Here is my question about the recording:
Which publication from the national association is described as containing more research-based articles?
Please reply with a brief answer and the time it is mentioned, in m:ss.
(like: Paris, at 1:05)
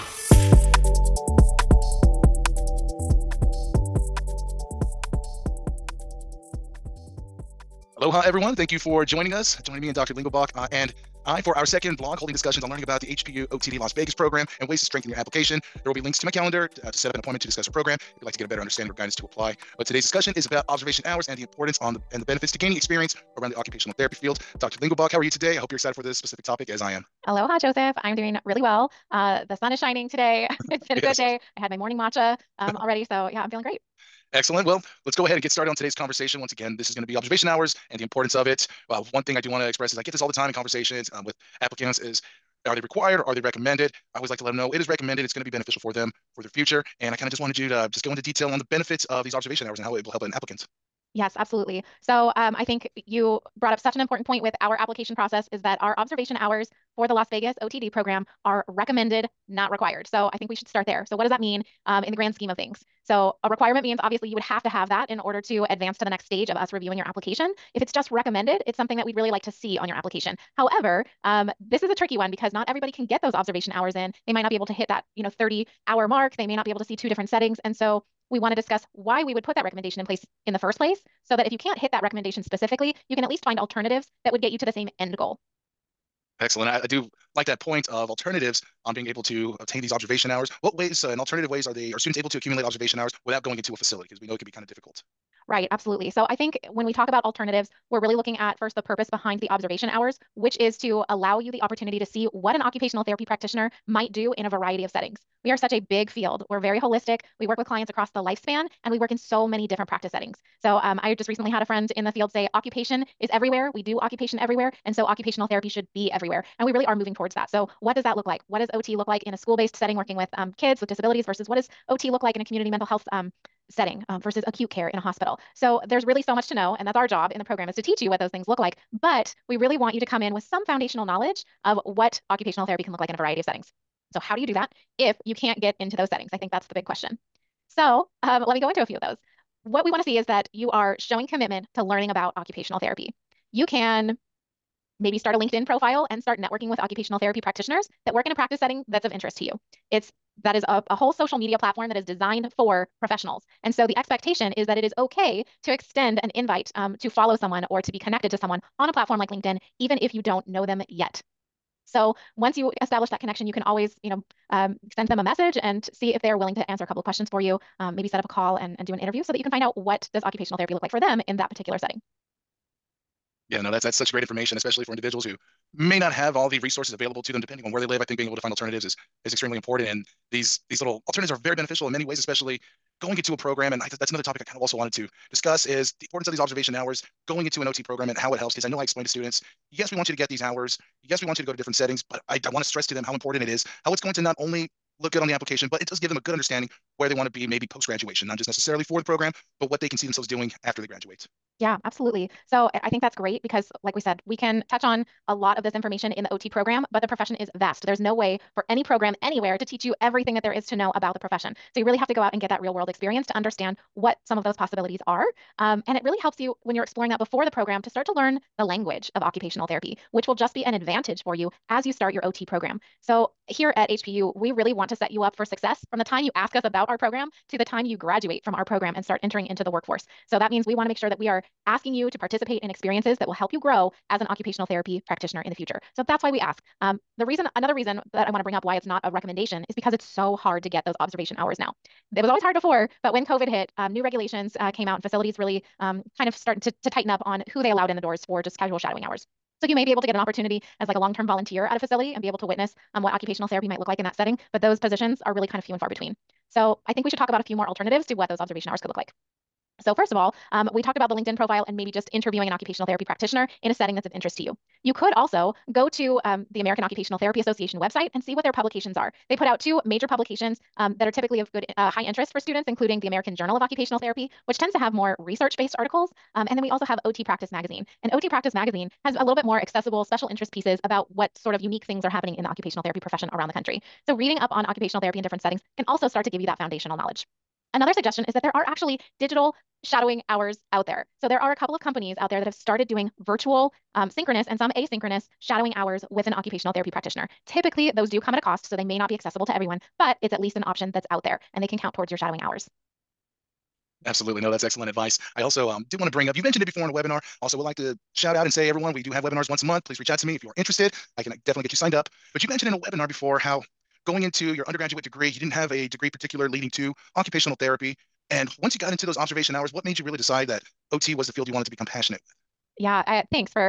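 American Journal of Occupational Therapy, at 4:33.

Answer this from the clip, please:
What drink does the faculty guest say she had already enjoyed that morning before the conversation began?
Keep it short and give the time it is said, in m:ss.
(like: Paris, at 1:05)
matcha, at 0:31.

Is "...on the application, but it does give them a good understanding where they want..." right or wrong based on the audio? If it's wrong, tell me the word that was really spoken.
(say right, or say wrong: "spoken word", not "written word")
right.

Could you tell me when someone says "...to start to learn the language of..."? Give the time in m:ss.
3:37.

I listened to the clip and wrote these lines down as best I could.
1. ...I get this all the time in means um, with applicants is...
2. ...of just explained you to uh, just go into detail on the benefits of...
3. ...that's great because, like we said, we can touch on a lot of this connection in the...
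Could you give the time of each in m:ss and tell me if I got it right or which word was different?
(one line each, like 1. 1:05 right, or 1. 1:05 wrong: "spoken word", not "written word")
1. 0:39 wrong: "conversations", not "means"
2. 0:47 wrong: "wanted", not "explained"
3. 3:23 wrong: "information", not "connection".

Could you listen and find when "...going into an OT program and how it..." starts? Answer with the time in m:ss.
3:07.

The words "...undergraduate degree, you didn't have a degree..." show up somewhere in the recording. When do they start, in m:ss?
5:14.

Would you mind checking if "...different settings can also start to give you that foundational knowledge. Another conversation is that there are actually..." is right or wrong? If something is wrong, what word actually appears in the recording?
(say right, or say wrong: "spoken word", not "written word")
wrong: "suggestion", not "conversation".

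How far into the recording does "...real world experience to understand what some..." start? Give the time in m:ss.
3:32.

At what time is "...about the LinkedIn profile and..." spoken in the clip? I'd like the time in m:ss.
4:20.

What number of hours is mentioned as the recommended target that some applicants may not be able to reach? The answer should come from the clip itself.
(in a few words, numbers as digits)
30.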